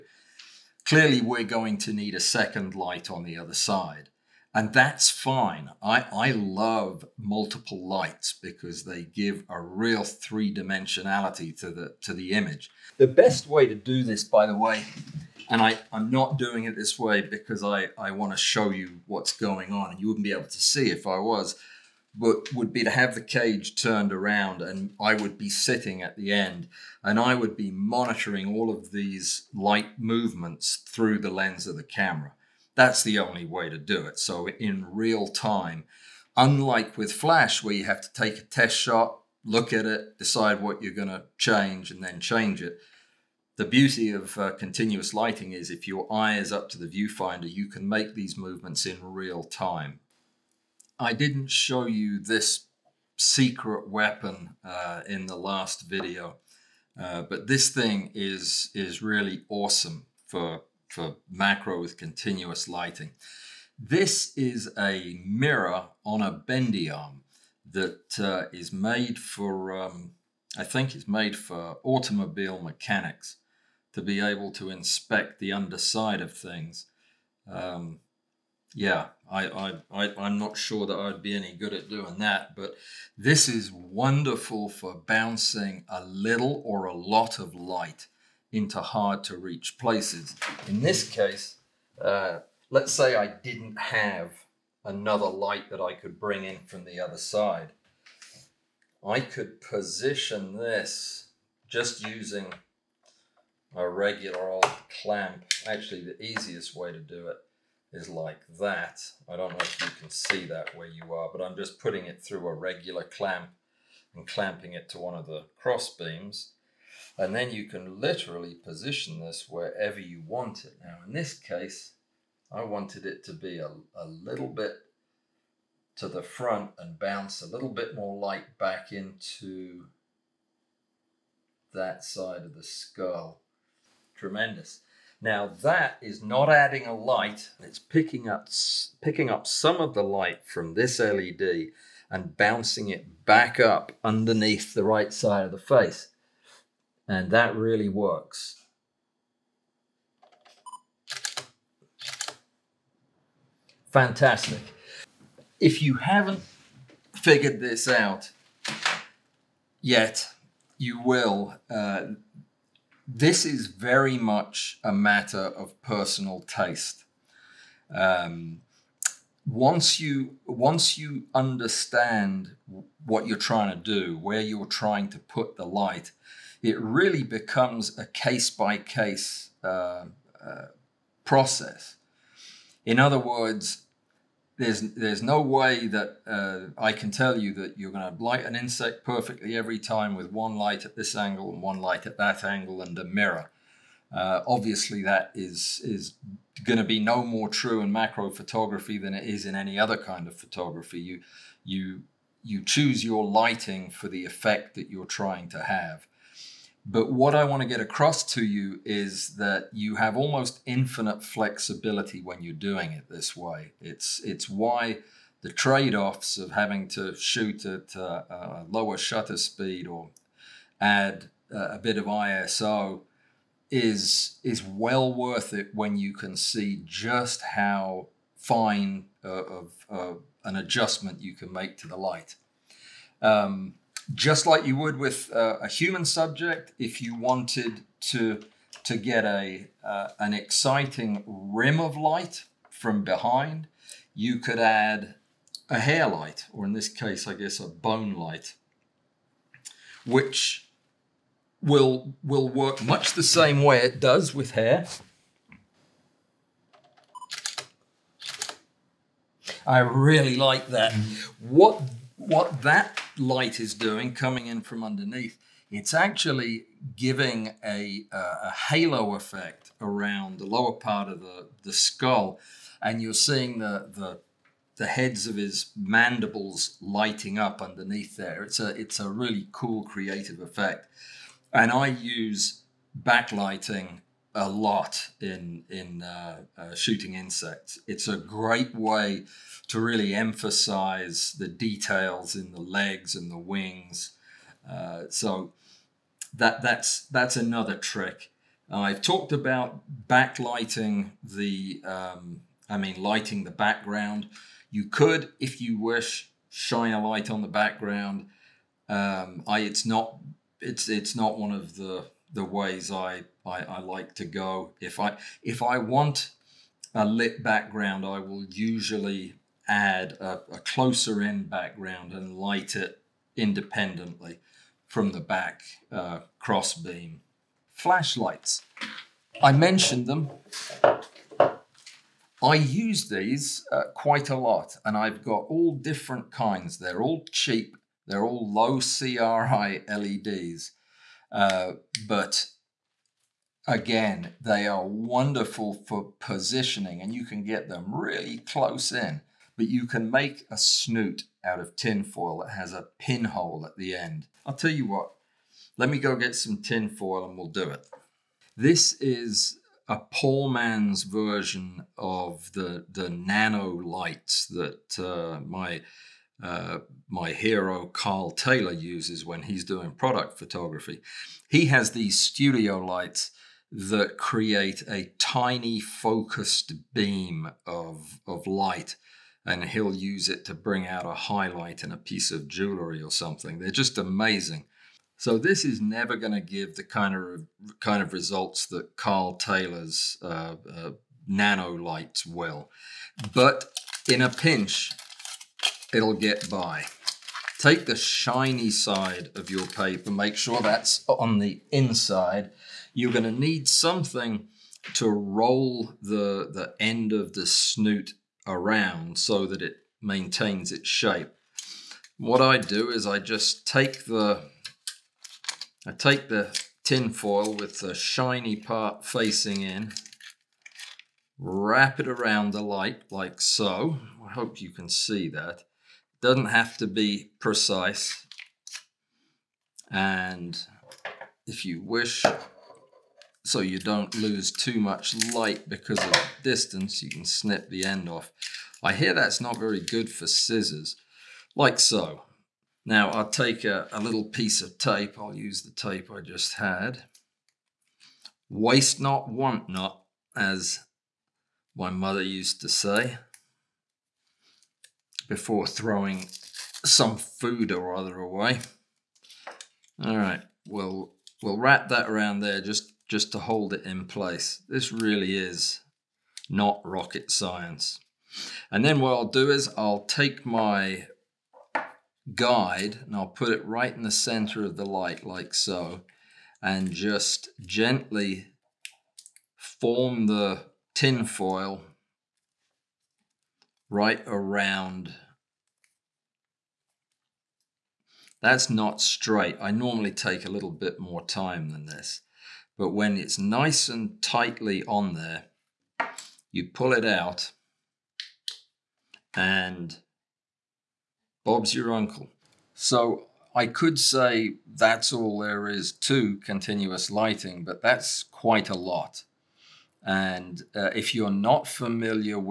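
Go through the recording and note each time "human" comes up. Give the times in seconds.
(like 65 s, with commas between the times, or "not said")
235 s.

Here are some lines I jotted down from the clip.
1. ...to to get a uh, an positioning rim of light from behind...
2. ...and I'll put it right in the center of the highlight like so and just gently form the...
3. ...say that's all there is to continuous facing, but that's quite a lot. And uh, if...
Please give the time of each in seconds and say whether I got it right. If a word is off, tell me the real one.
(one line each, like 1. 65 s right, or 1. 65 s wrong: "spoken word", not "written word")
1. 237 s wrong: "exciting", not "positioning"
2. 473 s wrong: "light", not "highlight"
3. 503 s wrong: "lighting", not "facing".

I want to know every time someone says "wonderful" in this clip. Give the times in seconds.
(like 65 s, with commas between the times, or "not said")
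83 s, 344 s.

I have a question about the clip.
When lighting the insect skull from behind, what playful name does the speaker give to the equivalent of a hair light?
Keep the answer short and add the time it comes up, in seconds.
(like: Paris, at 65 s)
bone light, at 247 s.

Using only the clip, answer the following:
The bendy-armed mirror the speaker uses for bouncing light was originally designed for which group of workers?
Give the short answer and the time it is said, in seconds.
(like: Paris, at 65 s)
automobile mechanics, at 71 s.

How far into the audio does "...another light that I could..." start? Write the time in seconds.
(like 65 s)
94 s.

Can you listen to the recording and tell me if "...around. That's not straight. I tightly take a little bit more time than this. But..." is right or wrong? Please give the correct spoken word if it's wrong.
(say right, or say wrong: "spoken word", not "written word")
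wrong: "normally", not "tightly".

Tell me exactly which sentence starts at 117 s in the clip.
And then you can literally position this wherever you want it.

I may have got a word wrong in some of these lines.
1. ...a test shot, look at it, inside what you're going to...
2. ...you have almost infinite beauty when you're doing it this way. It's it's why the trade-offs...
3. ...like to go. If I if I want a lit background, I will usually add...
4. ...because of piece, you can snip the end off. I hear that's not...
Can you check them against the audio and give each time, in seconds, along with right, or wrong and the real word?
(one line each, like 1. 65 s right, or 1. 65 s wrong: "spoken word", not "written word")
1. 38 s wrong: "decide", not "inside"
2. 209 s wrong: "flexibility", not "beauty"
3. 313 s right
4. 435 s wrong: "distance", not "piece".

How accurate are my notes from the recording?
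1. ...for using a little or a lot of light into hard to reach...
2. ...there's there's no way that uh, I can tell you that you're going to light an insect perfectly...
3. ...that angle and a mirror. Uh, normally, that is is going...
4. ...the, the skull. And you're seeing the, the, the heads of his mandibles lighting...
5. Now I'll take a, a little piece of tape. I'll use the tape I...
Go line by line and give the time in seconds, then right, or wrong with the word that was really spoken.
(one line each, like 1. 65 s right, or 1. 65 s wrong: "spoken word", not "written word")
1. 84 s wrong: "bouncing", not "using"
2. 184 s right
3. 192 s wrong: "obviously", not "normally"
4. 271 s right
5. 442 s right.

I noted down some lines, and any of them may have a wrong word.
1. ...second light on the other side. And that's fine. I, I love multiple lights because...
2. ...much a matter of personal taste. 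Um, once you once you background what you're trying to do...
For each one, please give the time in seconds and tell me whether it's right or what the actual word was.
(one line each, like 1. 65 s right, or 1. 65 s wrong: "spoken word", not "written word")
1. 2 s right
2. 164 s wrong: "understand", not "background".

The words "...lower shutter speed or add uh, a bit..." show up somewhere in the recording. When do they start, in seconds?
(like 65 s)
218 s.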